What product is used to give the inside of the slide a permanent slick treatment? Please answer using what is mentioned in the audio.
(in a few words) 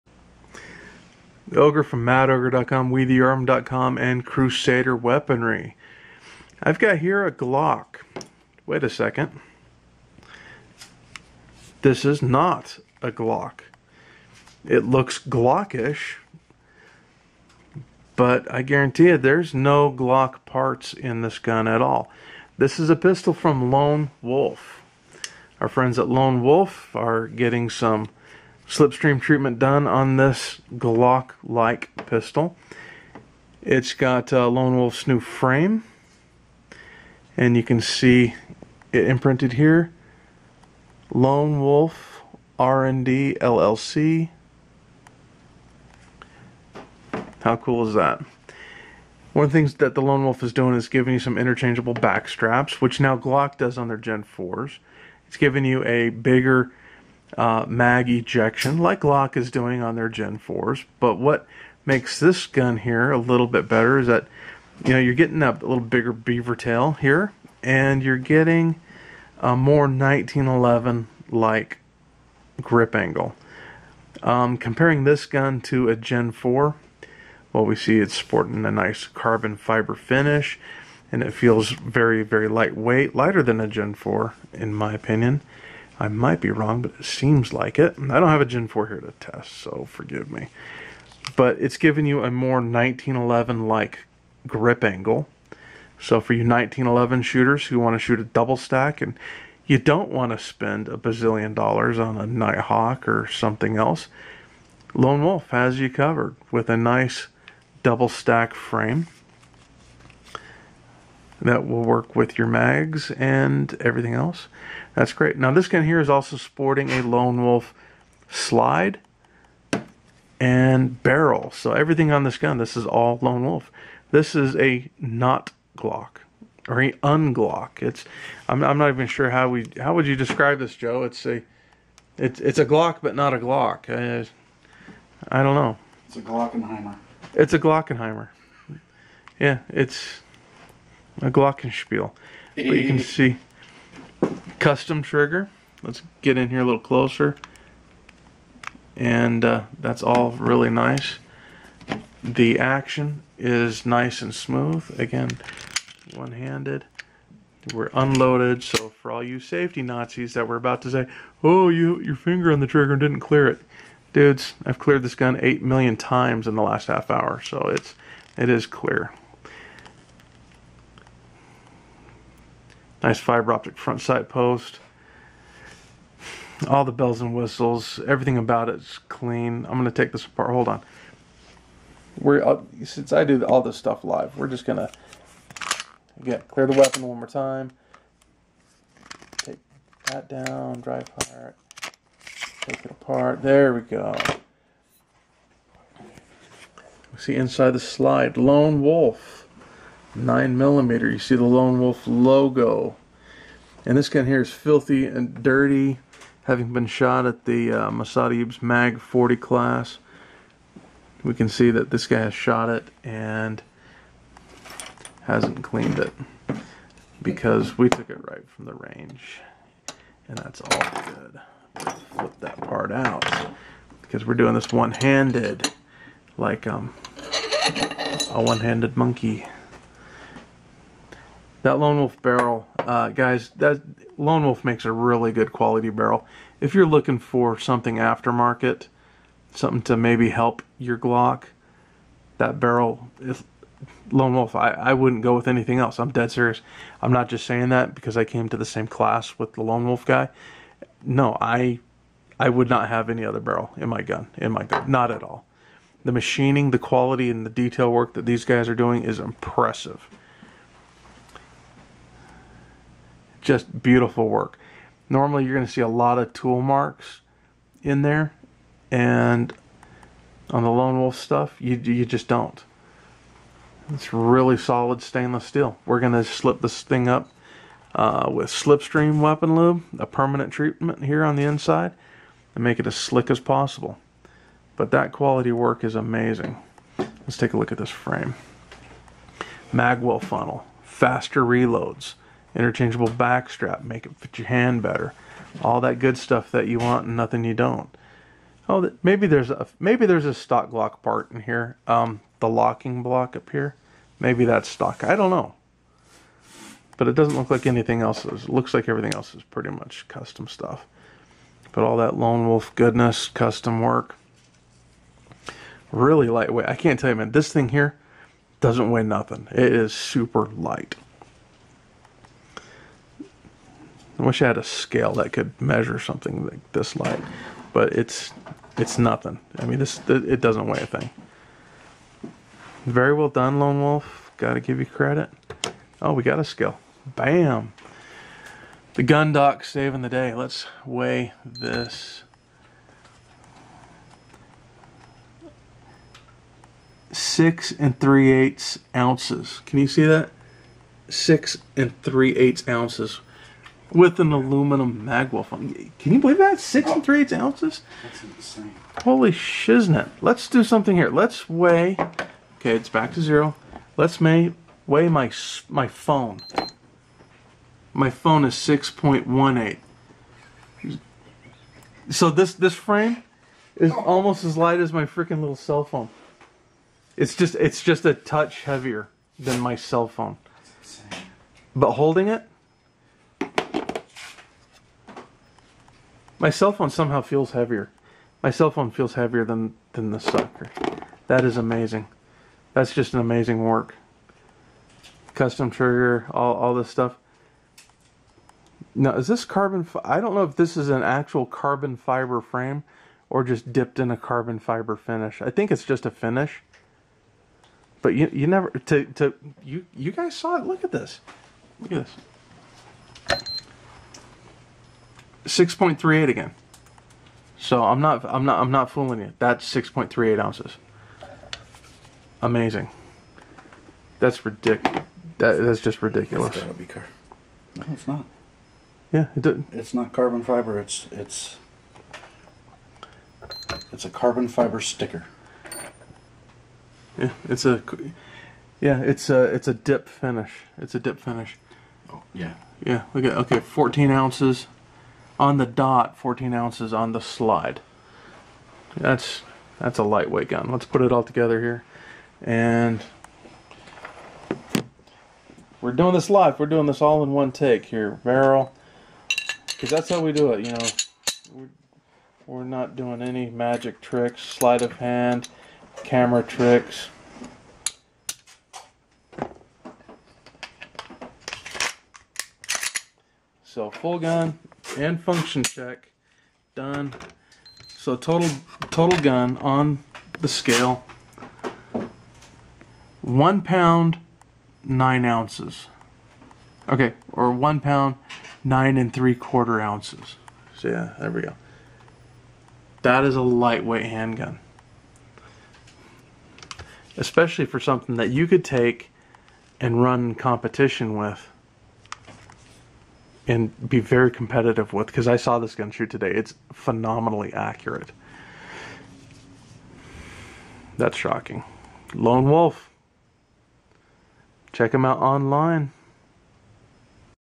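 Slipstream Weapon Lube.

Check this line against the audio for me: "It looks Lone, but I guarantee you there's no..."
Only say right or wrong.
wrong.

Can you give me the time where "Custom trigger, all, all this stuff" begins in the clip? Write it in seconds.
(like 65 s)
395 s.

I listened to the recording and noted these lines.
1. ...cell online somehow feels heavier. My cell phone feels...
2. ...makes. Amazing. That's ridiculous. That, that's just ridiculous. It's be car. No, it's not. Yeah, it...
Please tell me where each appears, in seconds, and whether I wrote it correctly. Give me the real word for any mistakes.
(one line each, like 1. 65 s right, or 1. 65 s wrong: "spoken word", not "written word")
1. 386 s wrong: "phone", not "online"
2. 420 s wrong: "ounces", not "makes".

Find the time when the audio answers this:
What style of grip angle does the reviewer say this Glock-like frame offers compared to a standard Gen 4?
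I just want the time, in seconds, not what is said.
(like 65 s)
69 s.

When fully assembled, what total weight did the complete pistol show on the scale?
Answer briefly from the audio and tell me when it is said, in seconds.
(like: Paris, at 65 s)
1 pound 9 3/4 ounces, at 487 s.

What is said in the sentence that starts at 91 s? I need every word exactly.
But it's giving you a more 1911-like grip angle.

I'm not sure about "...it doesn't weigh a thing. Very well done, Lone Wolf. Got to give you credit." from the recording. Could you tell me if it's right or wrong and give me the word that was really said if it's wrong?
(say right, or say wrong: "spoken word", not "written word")
right.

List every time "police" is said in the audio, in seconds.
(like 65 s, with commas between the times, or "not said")
not said.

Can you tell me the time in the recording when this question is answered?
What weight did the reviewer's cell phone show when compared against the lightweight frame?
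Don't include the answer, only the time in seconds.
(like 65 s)
368 s.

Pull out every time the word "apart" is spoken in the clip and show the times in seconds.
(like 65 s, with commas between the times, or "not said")
180 s, 192 s.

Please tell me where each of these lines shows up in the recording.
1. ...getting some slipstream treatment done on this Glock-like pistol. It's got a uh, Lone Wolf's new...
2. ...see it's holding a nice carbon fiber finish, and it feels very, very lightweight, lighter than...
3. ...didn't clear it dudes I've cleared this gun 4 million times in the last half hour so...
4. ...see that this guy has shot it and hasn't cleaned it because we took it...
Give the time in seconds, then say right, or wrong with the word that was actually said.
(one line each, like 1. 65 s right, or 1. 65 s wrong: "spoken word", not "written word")
1. 27 s right
2. 77 s wrong: "sporting", not "holding"
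3. 163 s wrong: "8", not "4"
4. 211 s right.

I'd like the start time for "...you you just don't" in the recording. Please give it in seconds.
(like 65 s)
271 s.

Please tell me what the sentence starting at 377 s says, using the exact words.
It's just, it's just a touch heavier than my cell phone.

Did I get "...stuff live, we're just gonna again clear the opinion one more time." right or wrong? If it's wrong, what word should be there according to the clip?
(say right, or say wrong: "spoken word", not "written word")
wrong: "weapon", not "opinion".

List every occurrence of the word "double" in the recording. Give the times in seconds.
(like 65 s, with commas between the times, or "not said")
98 s, 107 s.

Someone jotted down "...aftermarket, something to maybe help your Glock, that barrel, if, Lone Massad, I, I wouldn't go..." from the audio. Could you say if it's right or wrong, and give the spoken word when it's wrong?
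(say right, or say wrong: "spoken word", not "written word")
wrong: "Wolf", not "Massad".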